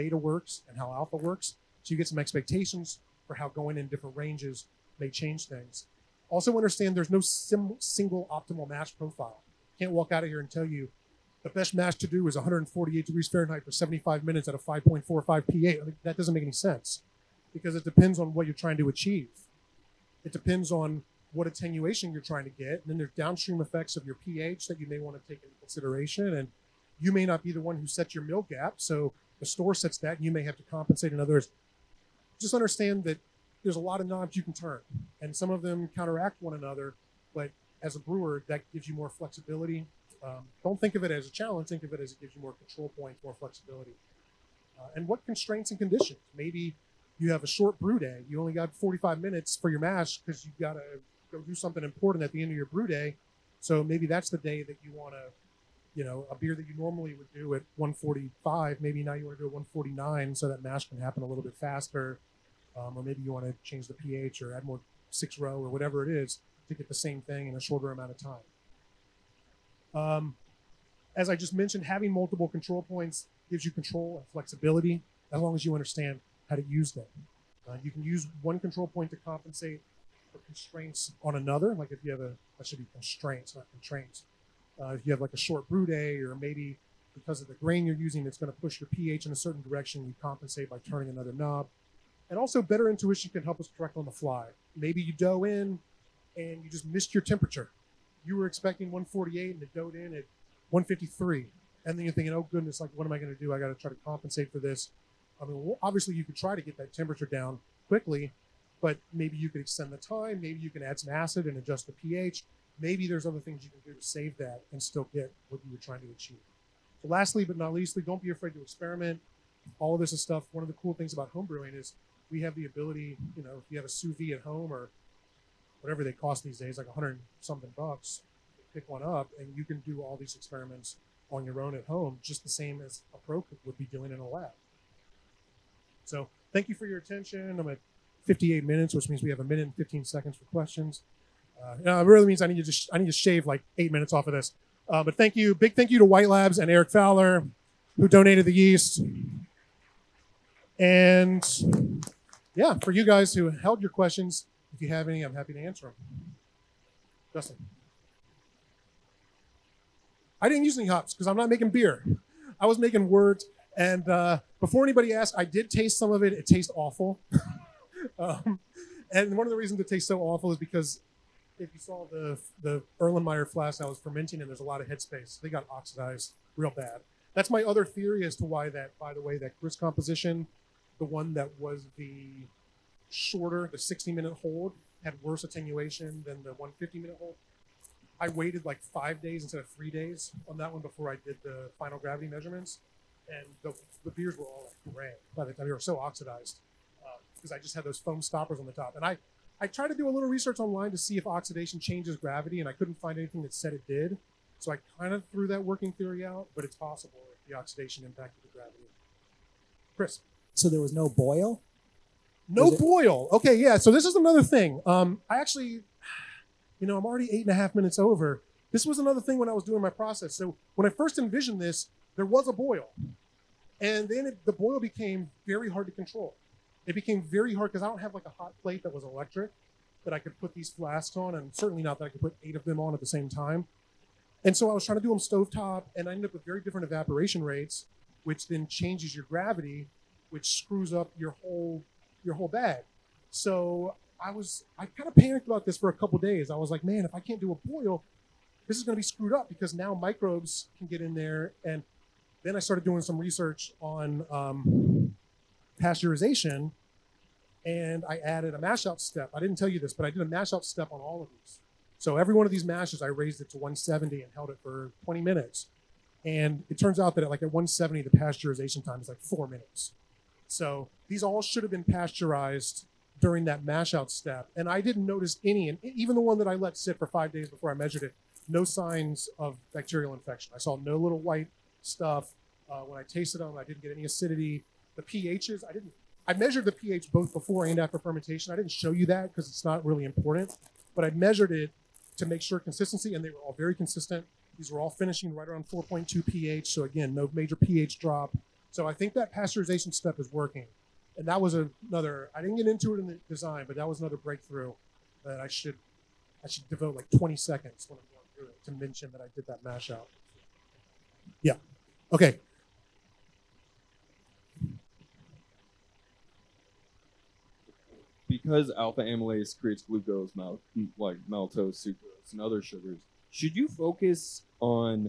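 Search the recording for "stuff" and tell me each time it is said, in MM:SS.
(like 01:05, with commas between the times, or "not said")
02:00, 04:41.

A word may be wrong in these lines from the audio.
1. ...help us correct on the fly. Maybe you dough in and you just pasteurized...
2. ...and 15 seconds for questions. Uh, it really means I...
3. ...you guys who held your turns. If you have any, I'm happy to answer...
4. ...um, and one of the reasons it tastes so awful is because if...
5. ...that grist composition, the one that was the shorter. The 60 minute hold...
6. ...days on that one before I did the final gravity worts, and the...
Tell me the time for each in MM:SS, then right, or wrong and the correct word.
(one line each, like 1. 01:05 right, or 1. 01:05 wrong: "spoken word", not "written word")
1. 01:33 wrong: "missed", not "pasteurized"
2. 02:19 right
3. 02:32 wrong: "questions", not "turns"
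4. 02:48 right
5. 02:59 right
6. 03:09 wrong: "measurements", not "worts".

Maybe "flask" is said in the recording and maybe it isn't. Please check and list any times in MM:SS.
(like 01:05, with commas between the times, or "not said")
02:53, 03:50.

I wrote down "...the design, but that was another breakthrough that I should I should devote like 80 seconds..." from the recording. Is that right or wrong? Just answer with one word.
wrong.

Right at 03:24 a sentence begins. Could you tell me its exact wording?
So I kind of threw that working theory out, but it's possible if the oxidation impacted the gravity.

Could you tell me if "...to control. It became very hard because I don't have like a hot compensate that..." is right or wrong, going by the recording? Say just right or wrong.
wrong.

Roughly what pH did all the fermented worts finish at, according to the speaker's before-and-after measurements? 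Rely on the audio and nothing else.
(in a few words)
4.2.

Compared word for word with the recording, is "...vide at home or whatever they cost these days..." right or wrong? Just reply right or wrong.
right.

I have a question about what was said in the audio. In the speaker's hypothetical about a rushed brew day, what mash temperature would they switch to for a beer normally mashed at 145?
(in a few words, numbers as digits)
149.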